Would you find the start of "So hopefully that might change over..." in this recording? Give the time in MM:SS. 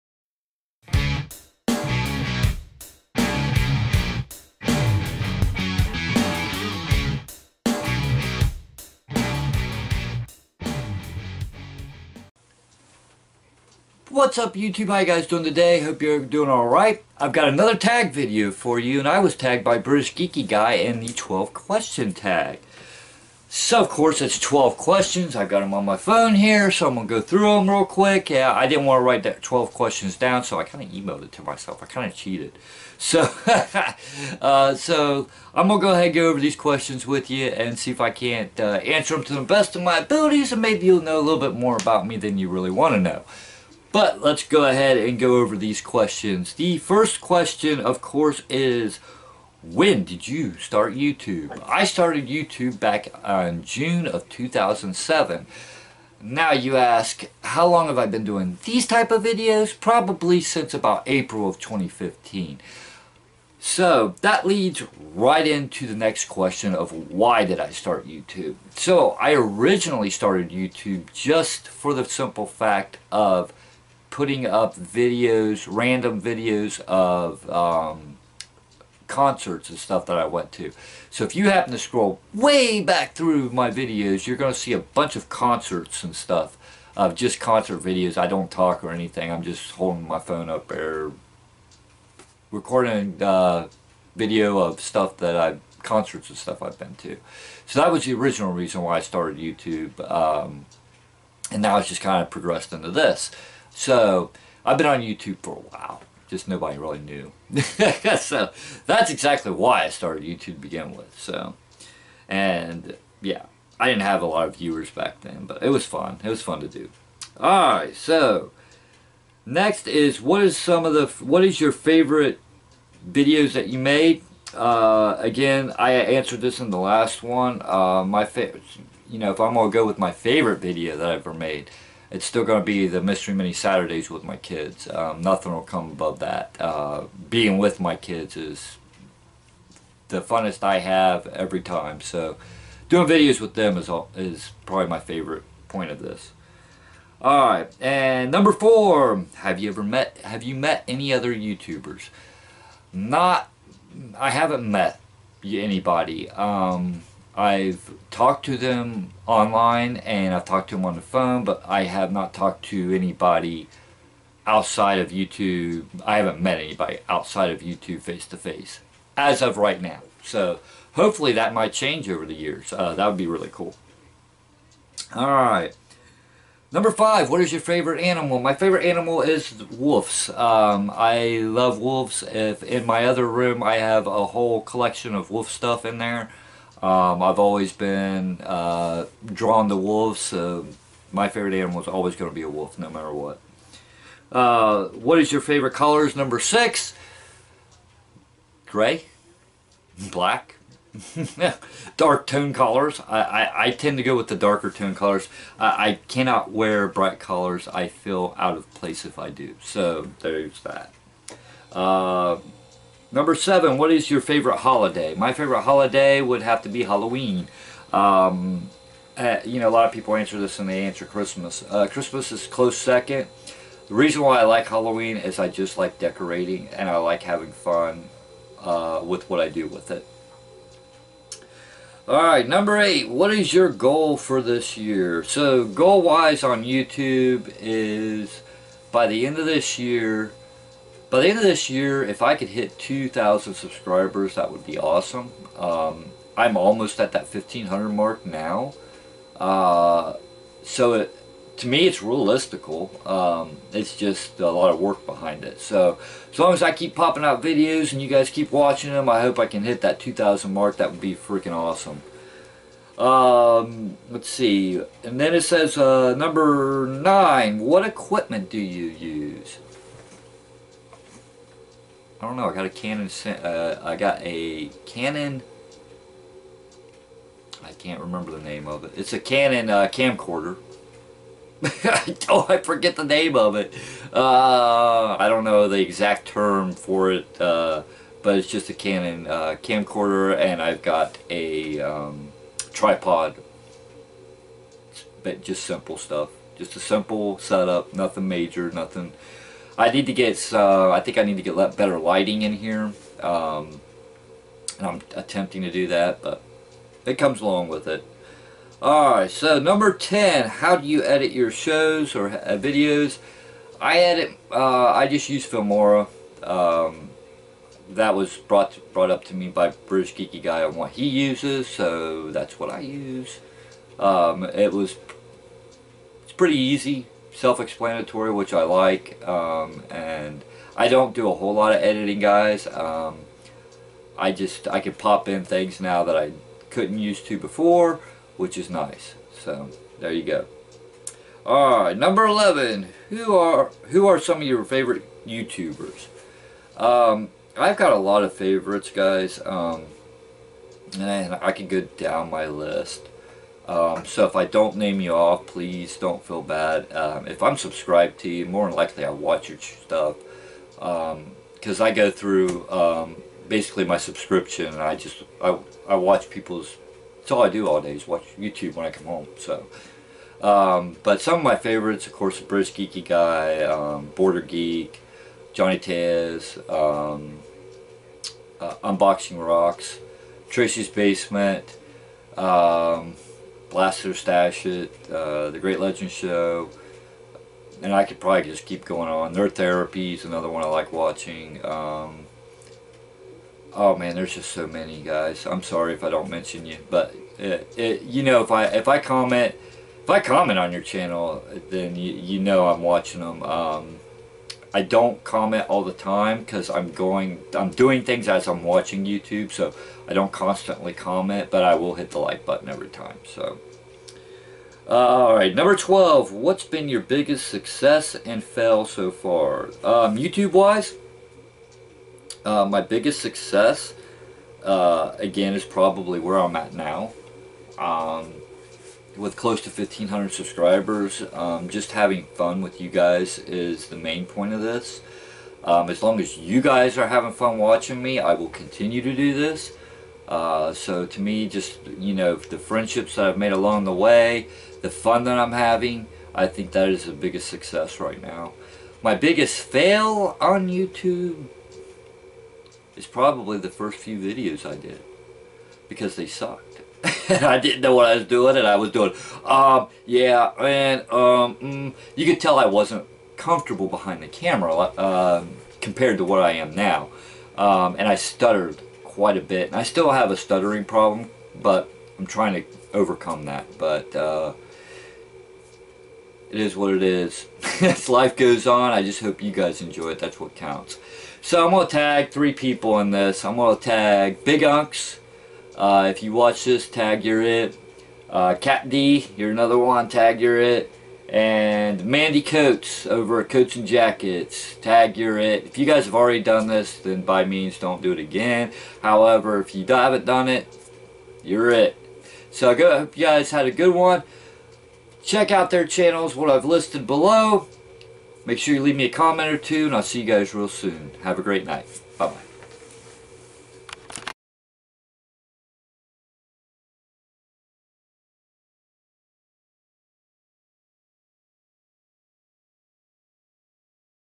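02:50.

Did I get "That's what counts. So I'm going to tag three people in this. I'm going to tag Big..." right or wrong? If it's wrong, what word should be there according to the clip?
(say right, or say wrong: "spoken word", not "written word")
right.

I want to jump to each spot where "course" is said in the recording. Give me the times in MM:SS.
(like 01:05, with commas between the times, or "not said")
00:23, 00:48, 06:12.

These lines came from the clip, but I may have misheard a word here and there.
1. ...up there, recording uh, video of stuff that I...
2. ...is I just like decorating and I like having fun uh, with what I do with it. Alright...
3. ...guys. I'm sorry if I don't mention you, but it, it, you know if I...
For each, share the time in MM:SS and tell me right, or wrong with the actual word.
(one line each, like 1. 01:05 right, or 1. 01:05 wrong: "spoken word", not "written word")
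1. 01:30 right
2. 03:45 right
3. 06:35 right.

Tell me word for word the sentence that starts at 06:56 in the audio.
What's been your biggest success and fail so far?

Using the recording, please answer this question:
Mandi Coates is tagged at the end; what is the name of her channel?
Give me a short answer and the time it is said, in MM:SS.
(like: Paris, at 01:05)
Coats and Jackets, at 08:13.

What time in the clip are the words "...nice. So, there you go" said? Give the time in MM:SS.
05:38.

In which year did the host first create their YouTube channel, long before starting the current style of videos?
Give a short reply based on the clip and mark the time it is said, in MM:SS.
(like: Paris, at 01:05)
2007, at 00:53.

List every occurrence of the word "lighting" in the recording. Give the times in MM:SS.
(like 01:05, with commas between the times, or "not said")
05:01.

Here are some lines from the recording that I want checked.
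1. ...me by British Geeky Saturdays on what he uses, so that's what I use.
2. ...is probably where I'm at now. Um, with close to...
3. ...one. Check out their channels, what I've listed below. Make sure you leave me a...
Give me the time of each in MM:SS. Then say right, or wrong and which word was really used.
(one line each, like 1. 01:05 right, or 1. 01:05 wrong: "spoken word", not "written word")
1. 05:19 wrong: "Guy", not "Saturdays"
2. 07:05 right
3. 08:23 right.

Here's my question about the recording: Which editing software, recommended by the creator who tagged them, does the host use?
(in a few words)
Filmora.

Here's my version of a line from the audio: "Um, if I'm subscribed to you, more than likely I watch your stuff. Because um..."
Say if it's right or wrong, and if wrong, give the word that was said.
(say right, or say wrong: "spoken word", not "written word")
right.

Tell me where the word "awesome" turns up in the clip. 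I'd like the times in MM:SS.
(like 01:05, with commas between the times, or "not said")
04:04, 04:21.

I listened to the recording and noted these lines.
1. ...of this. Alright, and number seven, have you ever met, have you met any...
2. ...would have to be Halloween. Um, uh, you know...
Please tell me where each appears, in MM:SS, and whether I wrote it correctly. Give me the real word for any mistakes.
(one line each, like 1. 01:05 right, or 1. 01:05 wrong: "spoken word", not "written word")
1. 02:25 wrong: "four", not "seven"
2. 03:36 right.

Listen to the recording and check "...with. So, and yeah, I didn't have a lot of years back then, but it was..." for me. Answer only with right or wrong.
wrong.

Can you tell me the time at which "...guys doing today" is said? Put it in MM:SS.
00:15.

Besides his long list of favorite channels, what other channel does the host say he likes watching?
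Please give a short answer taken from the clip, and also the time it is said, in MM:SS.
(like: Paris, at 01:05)
Nerd Therapy, at 06:29.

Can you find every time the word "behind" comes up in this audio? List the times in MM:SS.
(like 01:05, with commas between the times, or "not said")
04:15, 07:43.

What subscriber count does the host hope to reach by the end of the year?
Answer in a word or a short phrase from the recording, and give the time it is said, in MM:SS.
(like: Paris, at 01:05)
2,000, at 04:02.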